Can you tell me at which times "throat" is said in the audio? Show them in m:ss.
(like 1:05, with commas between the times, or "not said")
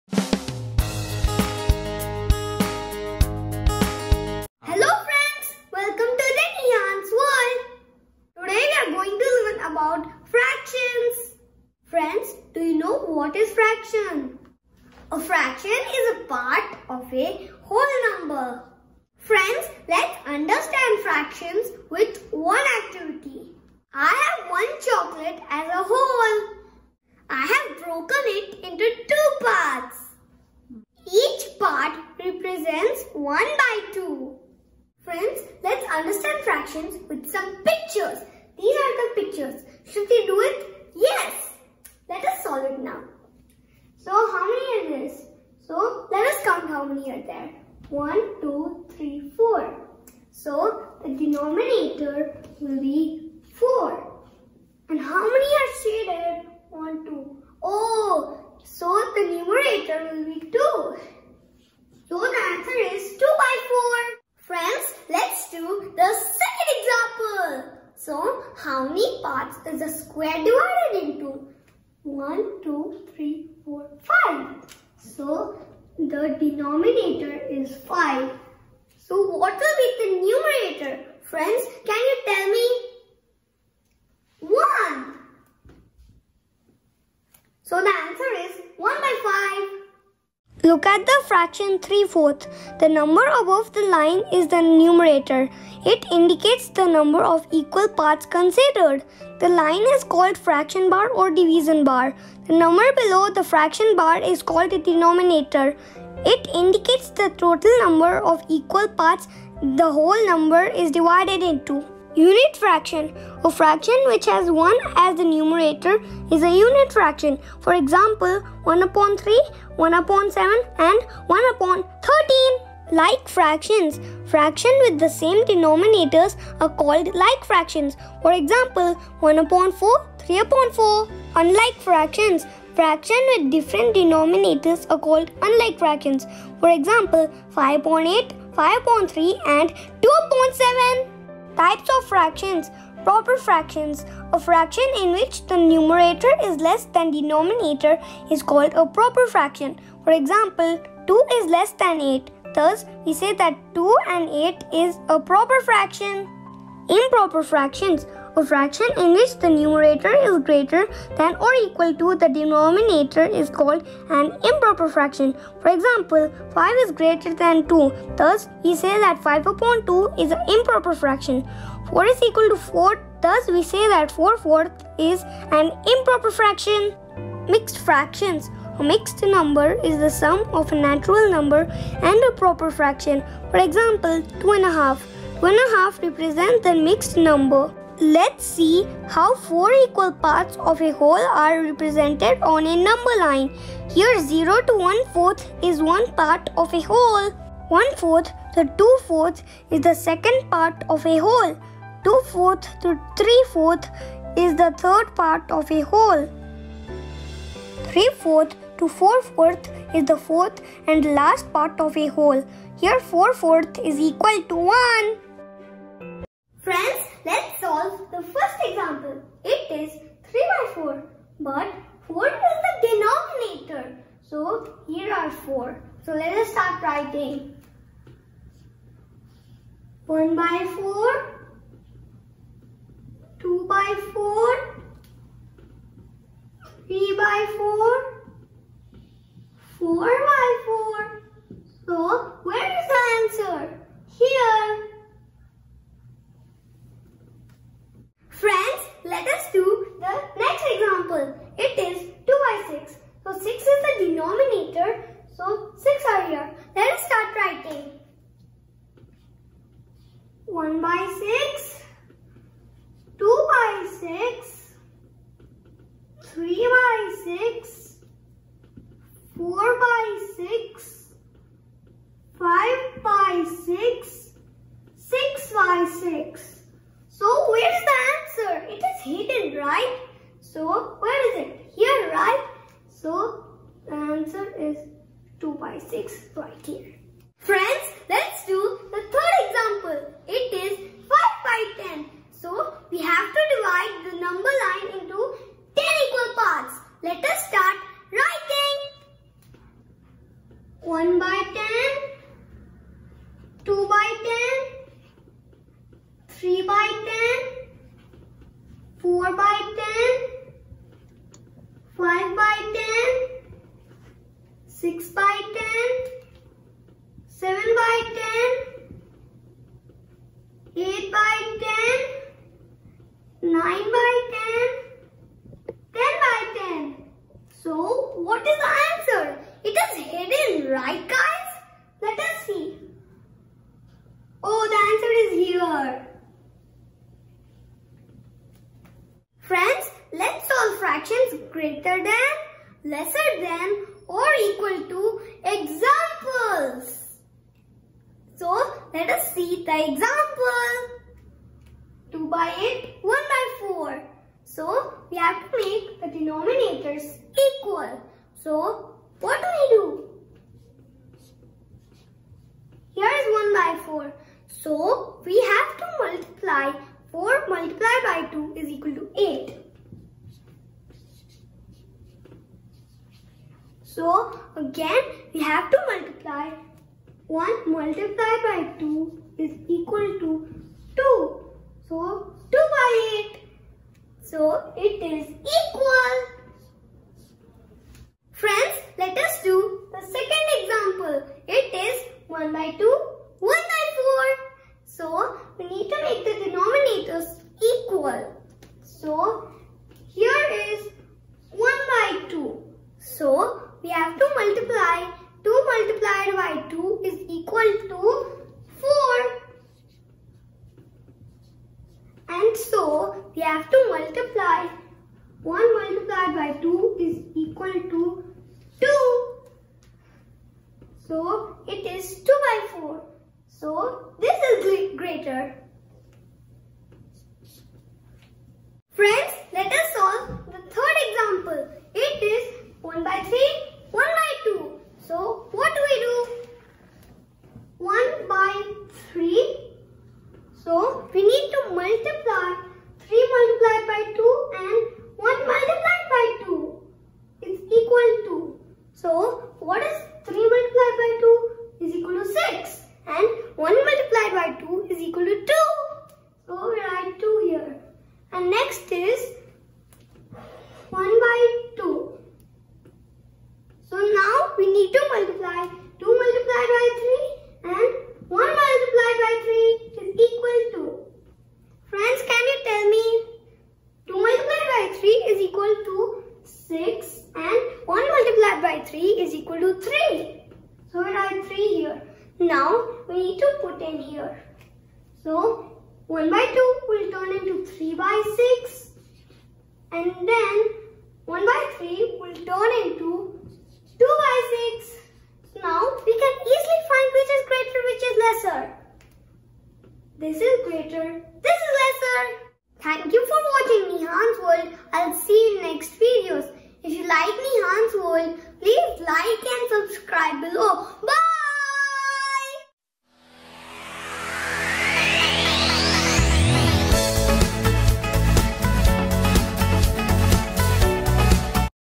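not said.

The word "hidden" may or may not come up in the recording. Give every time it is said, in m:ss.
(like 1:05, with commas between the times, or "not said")
4:39, 5:30.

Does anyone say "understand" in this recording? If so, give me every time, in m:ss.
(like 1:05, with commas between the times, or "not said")
0:20, 0:35.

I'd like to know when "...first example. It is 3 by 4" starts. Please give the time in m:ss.
3:38.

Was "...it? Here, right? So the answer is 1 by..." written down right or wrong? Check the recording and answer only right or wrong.
wrong.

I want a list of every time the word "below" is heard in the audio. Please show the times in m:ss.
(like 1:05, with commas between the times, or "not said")
1:43.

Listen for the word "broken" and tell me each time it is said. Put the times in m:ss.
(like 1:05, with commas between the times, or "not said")
0:27.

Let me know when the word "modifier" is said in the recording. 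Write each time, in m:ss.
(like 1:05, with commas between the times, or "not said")
not said.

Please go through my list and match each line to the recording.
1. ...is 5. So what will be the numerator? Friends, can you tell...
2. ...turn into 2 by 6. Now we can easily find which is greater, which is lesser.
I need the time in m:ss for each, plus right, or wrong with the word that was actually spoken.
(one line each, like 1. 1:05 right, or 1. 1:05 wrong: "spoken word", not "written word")
1. 1:17 right
2. 8:12 right.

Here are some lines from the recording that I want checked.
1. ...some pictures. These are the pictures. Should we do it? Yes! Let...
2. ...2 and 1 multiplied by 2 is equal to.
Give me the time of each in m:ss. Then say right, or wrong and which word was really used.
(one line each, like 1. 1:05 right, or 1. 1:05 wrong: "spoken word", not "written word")
1. 0:37 right
2. 7:24 right.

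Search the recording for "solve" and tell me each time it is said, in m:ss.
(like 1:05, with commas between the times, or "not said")
0:42, 3:37, 5:40, 7:09.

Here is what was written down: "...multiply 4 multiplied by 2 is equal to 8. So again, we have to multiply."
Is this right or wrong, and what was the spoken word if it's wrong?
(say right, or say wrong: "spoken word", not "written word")
right.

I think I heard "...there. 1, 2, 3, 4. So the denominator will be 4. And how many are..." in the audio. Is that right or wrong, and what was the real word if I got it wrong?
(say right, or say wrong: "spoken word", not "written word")
right.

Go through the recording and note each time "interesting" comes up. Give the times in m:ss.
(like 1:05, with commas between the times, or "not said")
not said.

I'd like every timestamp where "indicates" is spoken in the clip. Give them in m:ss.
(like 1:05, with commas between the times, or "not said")
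1:36, 1:46.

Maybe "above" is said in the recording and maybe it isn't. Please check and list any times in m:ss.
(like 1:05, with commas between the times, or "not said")
1:33.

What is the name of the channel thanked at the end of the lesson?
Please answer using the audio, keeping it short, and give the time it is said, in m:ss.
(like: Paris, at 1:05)
Nihaan's World, at 8:23.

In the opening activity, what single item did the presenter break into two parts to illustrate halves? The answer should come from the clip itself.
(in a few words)
chocolate.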